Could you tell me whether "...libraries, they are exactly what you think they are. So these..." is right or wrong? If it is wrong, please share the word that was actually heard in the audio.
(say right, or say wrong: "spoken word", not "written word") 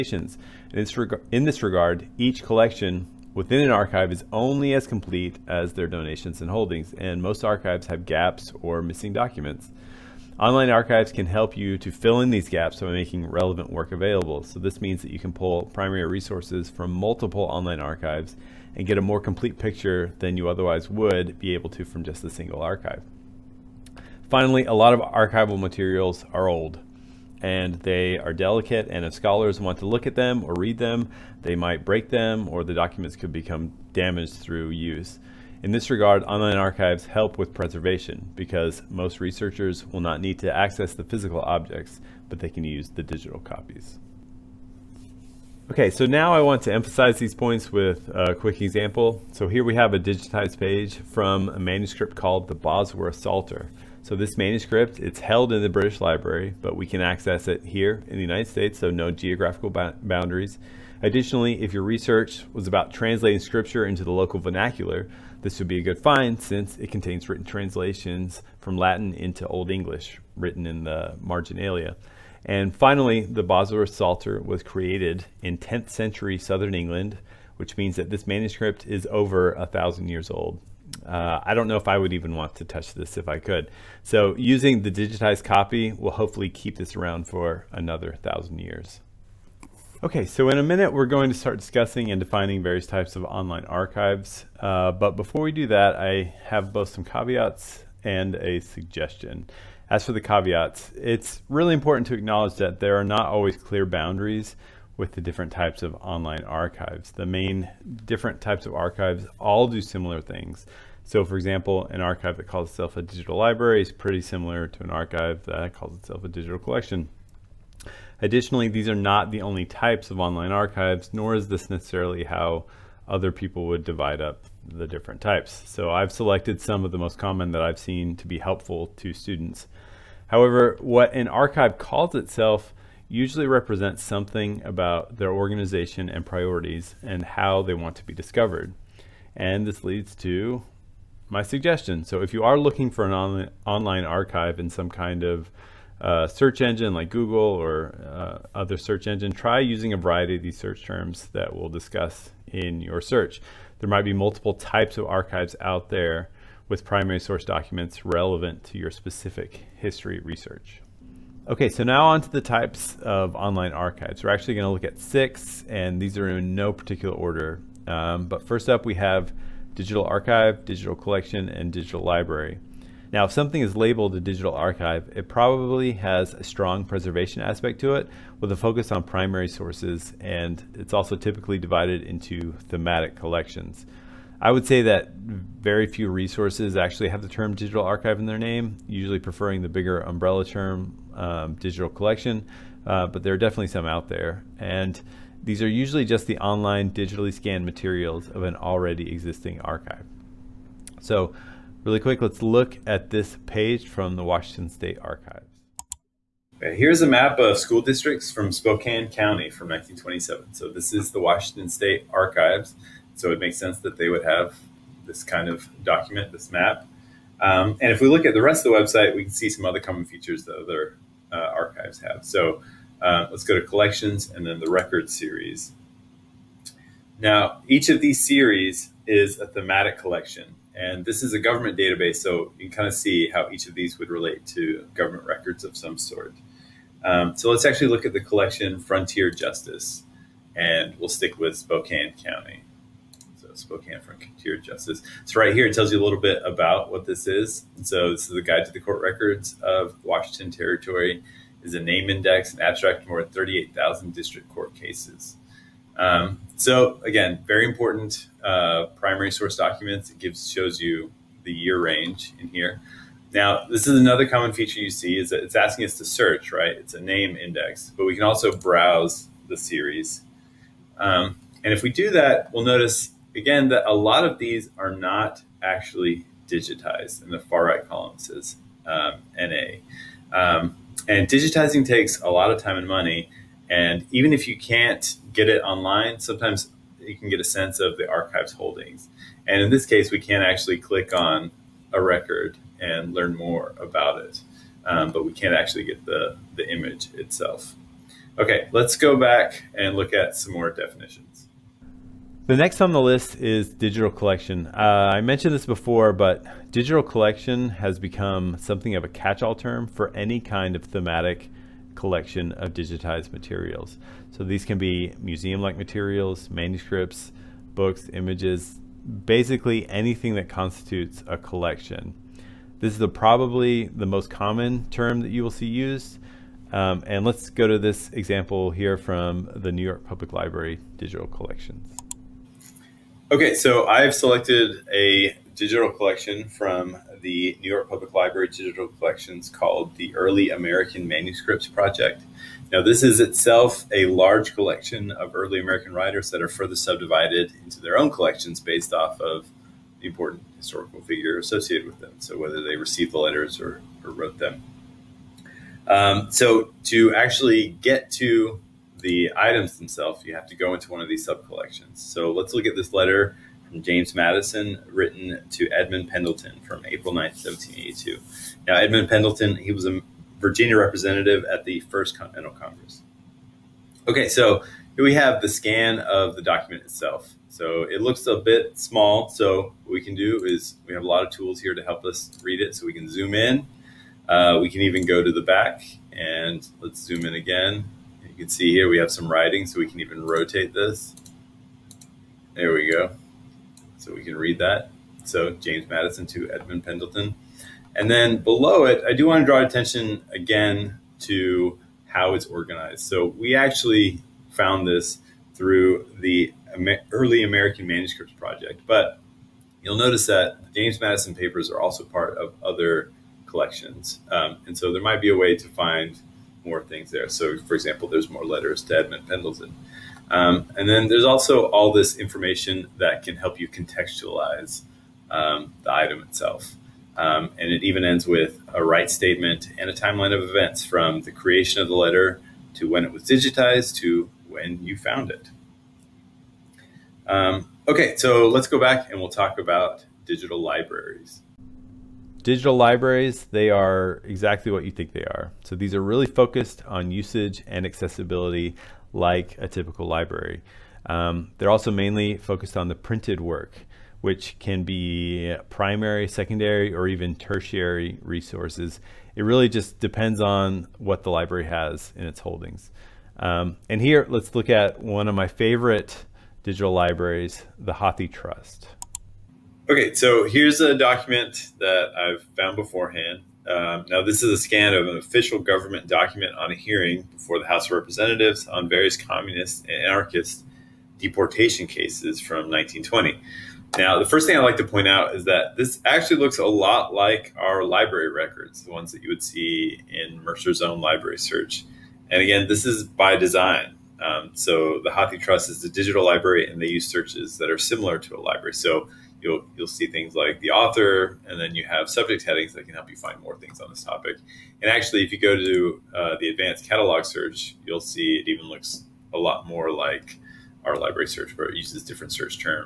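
right.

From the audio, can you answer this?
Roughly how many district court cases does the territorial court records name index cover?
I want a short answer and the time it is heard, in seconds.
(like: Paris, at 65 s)
38,000, at 253 s.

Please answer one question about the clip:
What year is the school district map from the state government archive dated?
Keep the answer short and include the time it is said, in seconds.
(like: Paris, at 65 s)
1927, at 209 s.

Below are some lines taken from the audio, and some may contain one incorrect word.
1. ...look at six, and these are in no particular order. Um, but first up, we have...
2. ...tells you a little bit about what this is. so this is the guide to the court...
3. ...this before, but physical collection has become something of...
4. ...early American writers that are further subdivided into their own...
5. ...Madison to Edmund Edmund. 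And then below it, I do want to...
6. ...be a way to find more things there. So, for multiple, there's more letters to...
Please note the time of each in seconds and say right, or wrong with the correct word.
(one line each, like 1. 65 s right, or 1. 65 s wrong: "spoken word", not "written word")
1. 164 s right
2. 245 s right
3. 305 s wrong: "digital", not "physical"
4. 345 s right
5. 395 s wrong: "Pendleton", not "Edmund"
6. 415 s wrong: "example", not "multiple".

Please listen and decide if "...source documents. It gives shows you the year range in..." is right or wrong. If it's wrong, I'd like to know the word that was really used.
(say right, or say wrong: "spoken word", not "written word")
right.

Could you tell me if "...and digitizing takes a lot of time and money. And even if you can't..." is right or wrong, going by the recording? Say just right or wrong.
right.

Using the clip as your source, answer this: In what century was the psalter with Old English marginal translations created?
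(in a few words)
10th century.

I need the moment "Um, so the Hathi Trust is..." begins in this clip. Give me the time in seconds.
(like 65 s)
494 s.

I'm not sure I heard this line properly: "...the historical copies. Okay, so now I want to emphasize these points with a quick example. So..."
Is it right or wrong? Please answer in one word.
wrong.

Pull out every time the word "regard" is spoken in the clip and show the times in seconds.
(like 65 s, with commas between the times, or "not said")
1 s, 35 s.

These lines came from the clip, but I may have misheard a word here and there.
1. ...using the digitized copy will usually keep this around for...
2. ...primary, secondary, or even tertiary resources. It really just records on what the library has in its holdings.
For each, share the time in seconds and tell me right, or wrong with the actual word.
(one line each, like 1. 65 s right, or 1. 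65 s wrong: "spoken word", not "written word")
1. 84 s wrong: "hopefully", not "usually"
2. 455 s wrong: "depends", not "records".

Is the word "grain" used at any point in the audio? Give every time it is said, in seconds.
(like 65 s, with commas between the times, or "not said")
not said.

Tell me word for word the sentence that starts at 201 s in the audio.
So really quick, let's look at this page from the Washington State Archives.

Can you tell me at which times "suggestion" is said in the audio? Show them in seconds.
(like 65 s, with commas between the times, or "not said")
98 s, 141 s.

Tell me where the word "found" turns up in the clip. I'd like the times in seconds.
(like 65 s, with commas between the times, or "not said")
404 s, 434 s, 472 s.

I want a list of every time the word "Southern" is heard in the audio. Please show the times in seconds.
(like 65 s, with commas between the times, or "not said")
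76 s.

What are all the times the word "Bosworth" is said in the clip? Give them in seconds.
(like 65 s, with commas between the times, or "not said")
52 s, 73 s.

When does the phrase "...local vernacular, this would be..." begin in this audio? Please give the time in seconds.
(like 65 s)
64 s.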